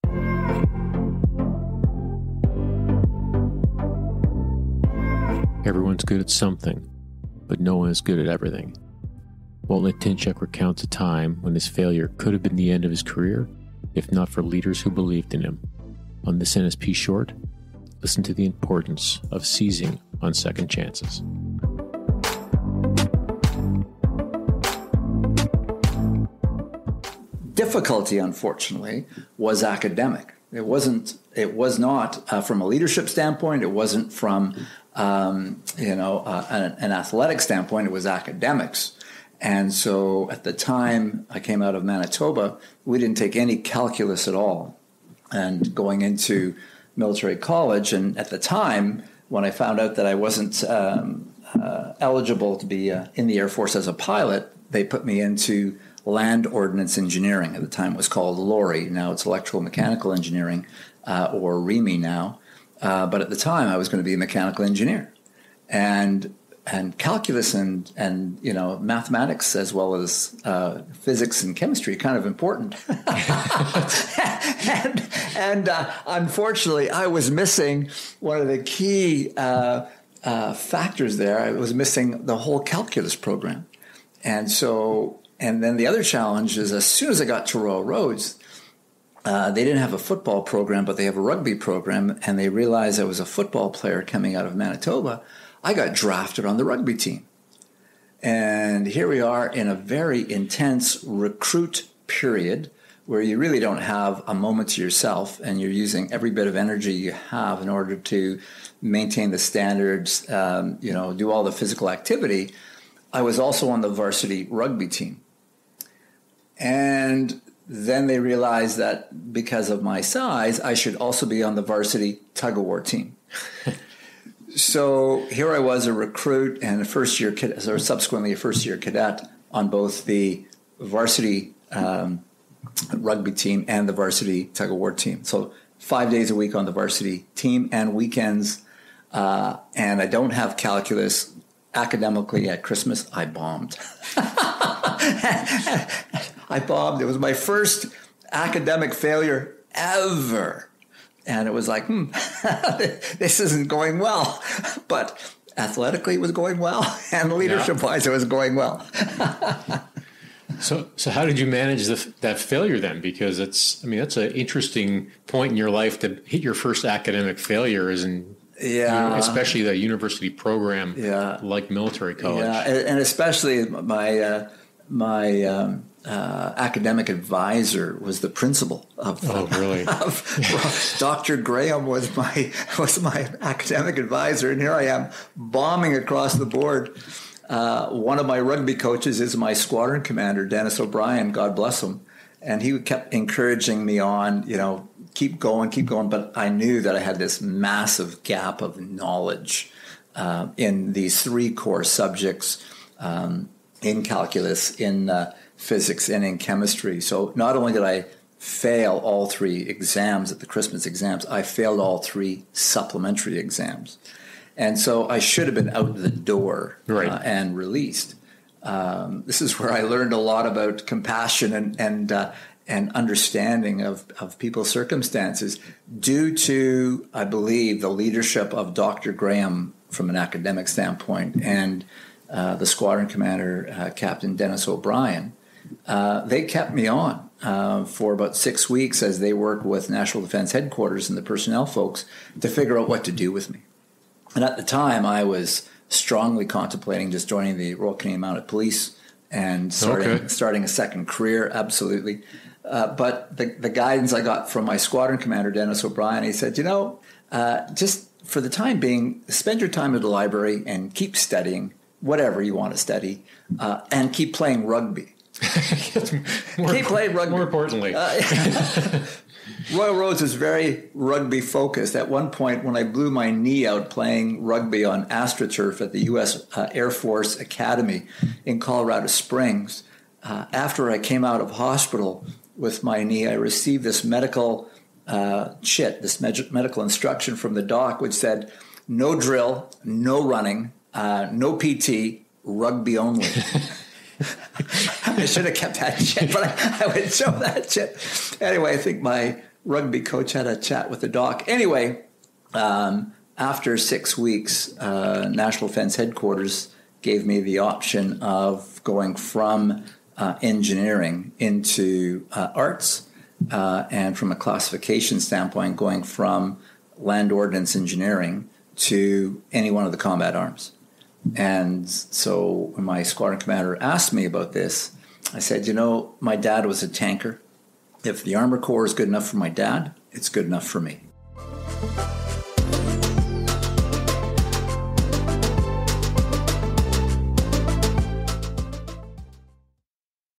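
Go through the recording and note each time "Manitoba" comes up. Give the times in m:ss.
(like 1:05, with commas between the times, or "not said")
0:41, 1:34.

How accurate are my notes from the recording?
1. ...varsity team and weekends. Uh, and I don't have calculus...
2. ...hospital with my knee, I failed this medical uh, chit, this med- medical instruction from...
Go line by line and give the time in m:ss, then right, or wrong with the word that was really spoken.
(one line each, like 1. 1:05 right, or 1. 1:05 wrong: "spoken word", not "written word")
1. 2:16 right
2. 4:41 wrong: "received", not "failed".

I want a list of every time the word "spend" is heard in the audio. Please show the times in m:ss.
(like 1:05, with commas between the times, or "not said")
4:19.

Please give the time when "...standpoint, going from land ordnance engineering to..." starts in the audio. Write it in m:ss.
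5:15.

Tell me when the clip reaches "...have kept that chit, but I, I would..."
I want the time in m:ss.
4:55.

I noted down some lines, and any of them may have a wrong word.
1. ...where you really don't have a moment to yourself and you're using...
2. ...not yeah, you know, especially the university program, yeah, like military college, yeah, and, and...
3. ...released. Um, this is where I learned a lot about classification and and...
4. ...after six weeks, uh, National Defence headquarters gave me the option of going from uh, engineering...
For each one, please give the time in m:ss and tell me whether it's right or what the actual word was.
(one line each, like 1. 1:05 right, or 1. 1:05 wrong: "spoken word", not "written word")
1. 1:43 right
2. 2:48 right
3. 3:37 wrong: "compassion", not "classification"
4. 5:03 right.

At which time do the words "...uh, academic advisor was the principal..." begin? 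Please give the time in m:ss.
2:56.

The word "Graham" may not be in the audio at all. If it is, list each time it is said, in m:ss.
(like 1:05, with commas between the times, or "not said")
3:01, 3:49.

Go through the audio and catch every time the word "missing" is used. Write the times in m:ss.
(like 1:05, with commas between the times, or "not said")
1:17, 1:21.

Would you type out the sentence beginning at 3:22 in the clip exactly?
Um, in calculus, in uh, physics, and in chemistry.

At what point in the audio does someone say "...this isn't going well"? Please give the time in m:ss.
2:33.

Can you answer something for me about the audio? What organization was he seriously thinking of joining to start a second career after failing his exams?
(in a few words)
Royal Canadian Mounted Police.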